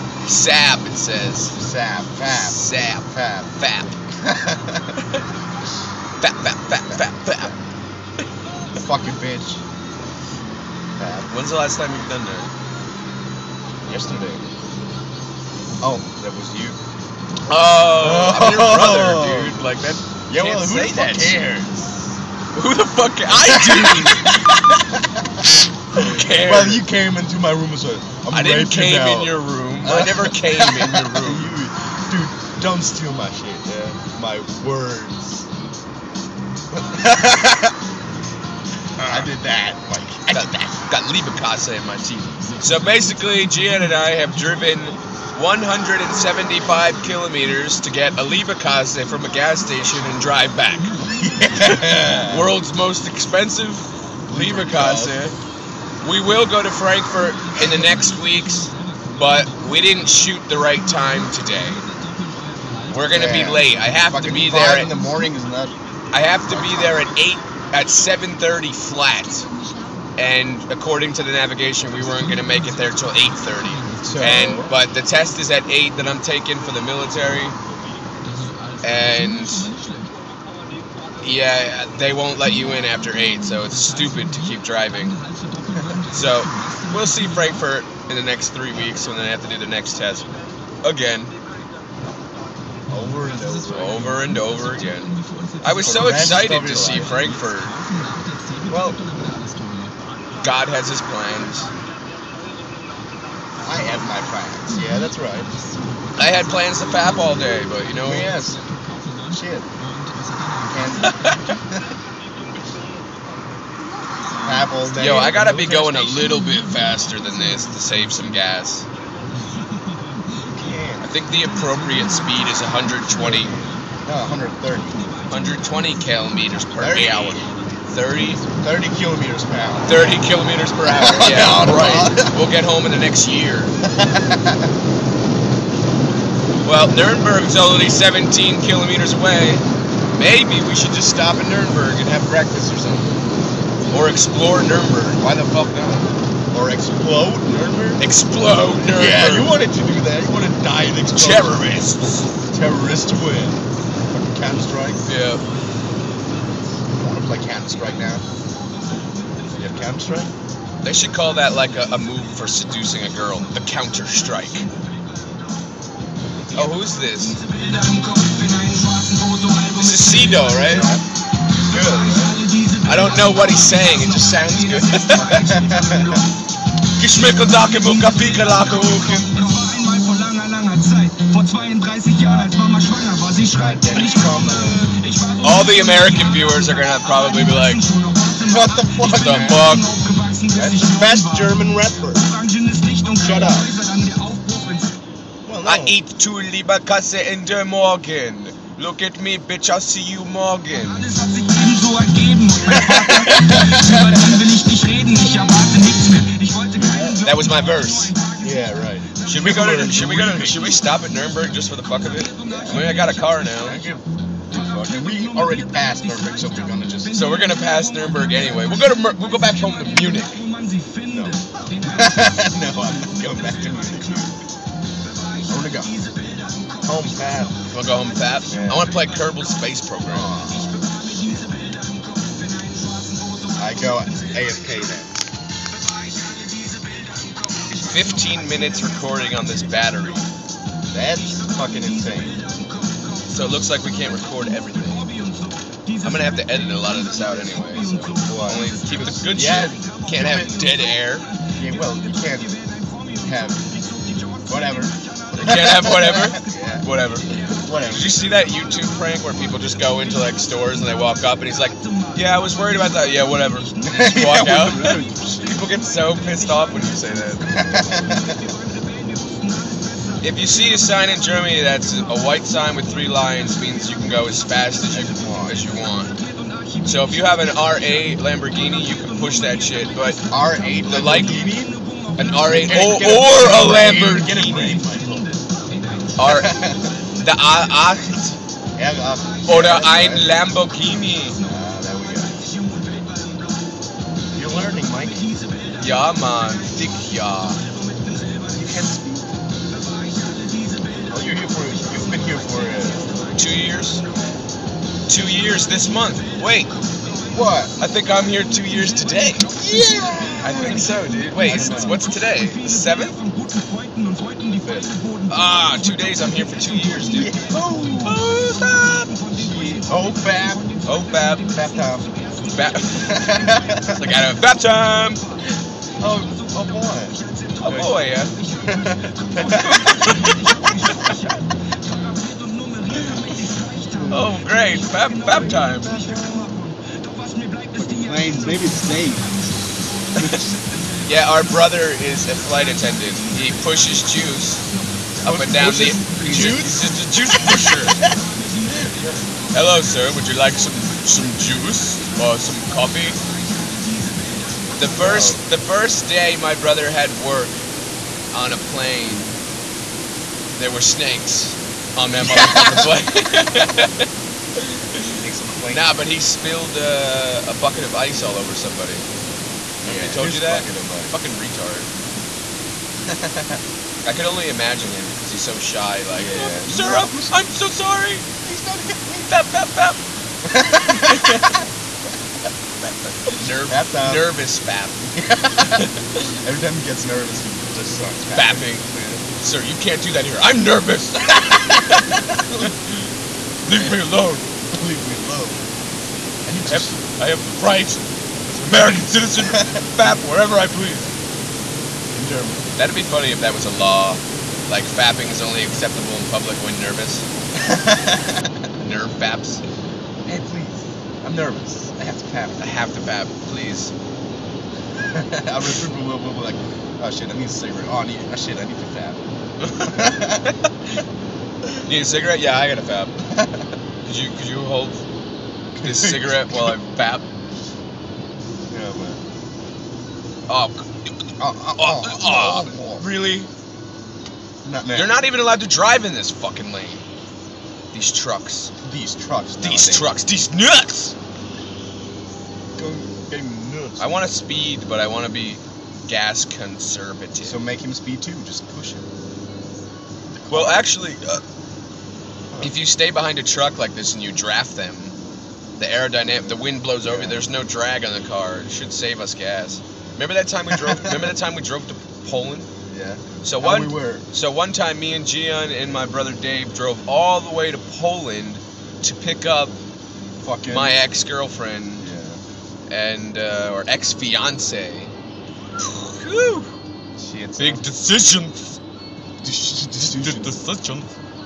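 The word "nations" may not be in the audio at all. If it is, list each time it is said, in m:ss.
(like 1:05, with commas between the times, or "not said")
not said.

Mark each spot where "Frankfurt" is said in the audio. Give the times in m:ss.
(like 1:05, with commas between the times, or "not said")
0:56, 1:27, 1:36.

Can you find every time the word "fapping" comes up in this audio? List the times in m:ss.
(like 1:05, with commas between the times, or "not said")
6:44.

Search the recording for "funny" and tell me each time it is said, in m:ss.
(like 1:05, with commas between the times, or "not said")
6:43.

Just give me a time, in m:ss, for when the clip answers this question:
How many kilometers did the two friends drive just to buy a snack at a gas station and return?
0:45.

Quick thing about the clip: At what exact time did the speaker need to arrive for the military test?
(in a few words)
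7:30.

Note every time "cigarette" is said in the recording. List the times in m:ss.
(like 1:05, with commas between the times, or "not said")
6:57, 7:02, 7:06.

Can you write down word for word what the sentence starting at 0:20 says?
Yeah, well, who the fuck cares?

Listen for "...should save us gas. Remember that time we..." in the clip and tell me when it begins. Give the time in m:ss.
7:38.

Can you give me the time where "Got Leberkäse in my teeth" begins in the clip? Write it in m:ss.
0:40.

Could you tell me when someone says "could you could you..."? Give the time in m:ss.
7:04.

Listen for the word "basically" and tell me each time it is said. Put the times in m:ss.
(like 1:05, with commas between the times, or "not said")
0:42.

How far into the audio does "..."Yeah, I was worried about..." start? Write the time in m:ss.
4:22.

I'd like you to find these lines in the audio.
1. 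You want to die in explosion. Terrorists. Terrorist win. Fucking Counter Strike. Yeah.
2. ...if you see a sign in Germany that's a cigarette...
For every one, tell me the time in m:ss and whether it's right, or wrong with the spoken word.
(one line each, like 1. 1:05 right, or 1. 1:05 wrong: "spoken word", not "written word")
1. 2:30 right
2. 4:30 wrong: "white", not "cigarette".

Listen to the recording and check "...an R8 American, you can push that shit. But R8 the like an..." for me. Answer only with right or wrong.
wrong.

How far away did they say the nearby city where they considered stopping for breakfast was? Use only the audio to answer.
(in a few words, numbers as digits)
17 kilometers.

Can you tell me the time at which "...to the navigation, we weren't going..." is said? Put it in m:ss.
1:11.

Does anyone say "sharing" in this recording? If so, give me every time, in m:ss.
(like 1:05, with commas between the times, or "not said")
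not said.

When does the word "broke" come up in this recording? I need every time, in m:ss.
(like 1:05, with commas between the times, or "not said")
not said.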